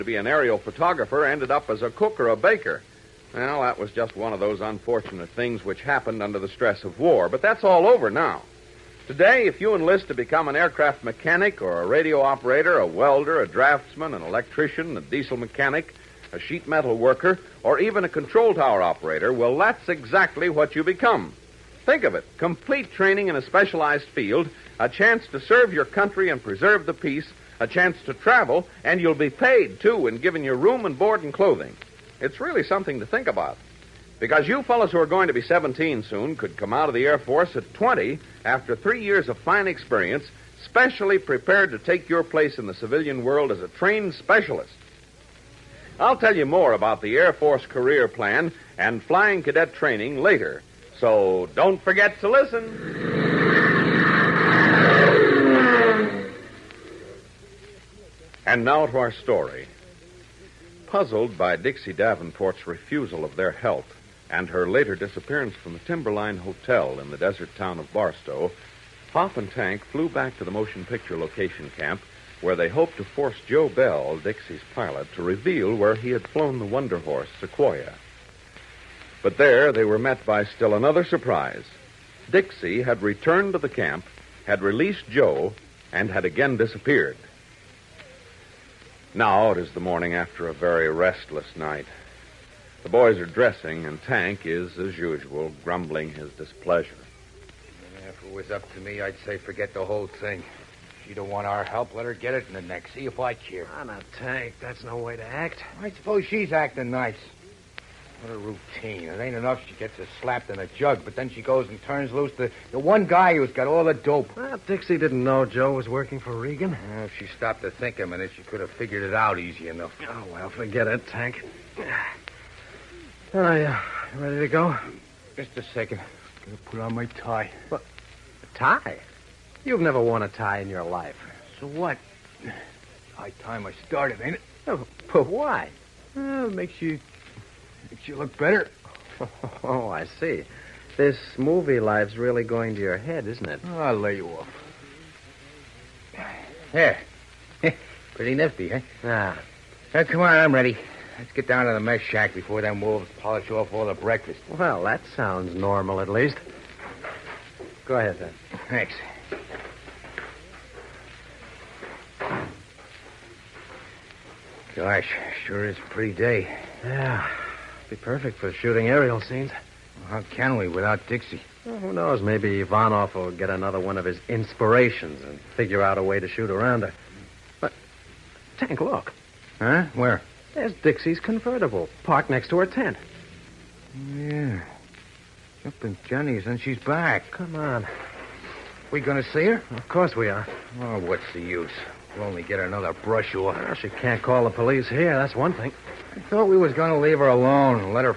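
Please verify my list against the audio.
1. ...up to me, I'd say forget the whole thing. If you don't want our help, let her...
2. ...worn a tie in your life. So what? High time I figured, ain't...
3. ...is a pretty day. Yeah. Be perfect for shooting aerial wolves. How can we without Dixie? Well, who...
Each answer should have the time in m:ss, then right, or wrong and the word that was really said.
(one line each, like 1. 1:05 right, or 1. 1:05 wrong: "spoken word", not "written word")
1. 1:38 right
2. 2:10 wrong: "started", not "figured"
3. 2:45 wrong: "scenes", not "wolves".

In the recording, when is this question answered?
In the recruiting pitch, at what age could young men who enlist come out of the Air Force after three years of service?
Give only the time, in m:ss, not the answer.
0:37.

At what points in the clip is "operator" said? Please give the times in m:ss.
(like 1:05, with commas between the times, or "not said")
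0:12, 0:18.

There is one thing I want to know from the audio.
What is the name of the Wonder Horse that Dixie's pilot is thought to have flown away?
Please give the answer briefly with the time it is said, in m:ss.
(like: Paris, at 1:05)
Sequoia, at 1:17.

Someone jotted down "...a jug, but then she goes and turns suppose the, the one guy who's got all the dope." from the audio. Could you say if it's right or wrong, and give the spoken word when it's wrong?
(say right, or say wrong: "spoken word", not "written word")
wrong: "loose", not "suppose".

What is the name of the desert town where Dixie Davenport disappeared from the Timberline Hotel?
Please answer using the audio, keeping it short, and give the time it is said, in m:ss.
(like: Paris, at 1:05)
Barstow, at 1:07.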